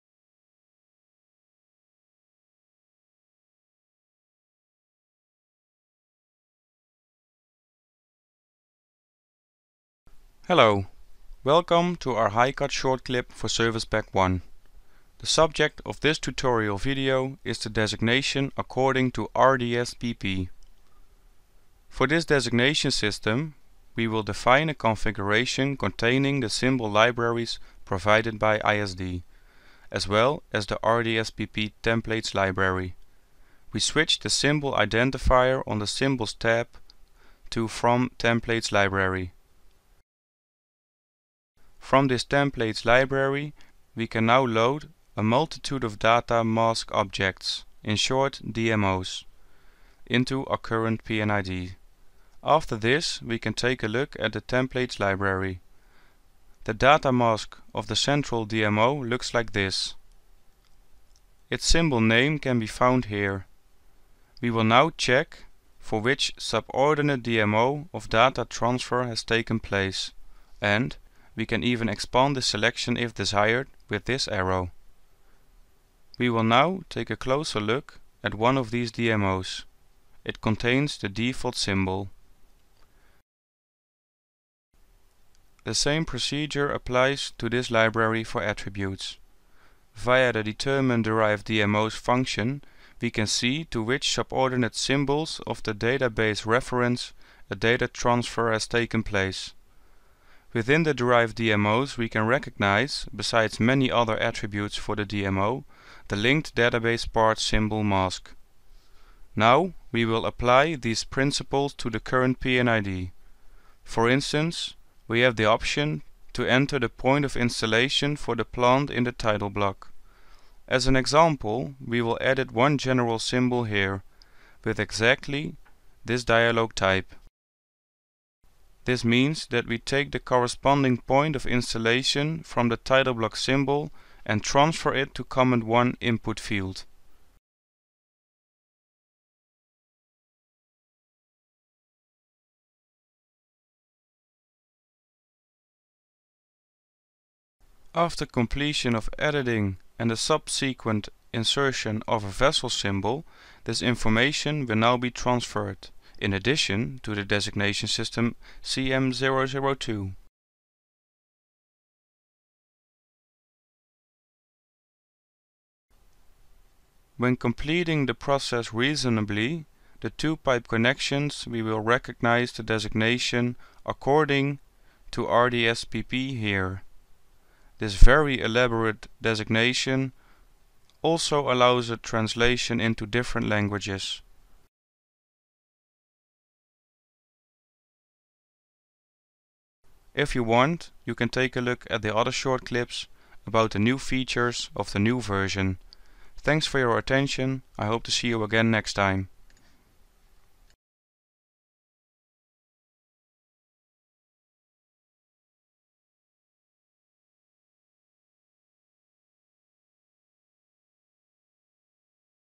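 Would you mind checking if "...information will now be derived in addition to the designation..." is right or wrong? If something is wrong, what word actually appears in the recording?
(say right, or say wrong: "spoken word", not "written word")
wrong: "transferred", not "derived".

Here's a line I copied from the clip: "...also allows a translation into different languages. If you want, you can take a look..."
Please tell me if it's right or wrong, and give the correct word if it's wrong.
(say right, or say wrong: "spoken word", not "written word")
right.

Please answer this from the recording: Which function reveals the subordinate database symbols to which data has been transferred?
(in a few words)
determine derived DMOs.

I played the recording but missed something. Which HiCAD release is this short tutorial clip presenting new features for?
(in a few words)
Service Pack 1.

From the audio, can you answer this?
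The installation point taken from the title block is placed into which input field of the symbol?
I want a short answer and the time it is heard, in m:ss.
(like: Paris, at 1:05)
comment 1, at 2:15.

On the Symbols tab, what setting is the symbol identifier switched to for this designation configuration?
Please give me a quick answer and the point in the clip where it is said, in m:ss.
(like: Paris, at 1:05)
From Templates library, at 0:37.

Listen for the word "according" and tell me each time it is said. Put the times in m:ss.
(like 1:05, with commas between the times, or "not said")
0:18, 2:53.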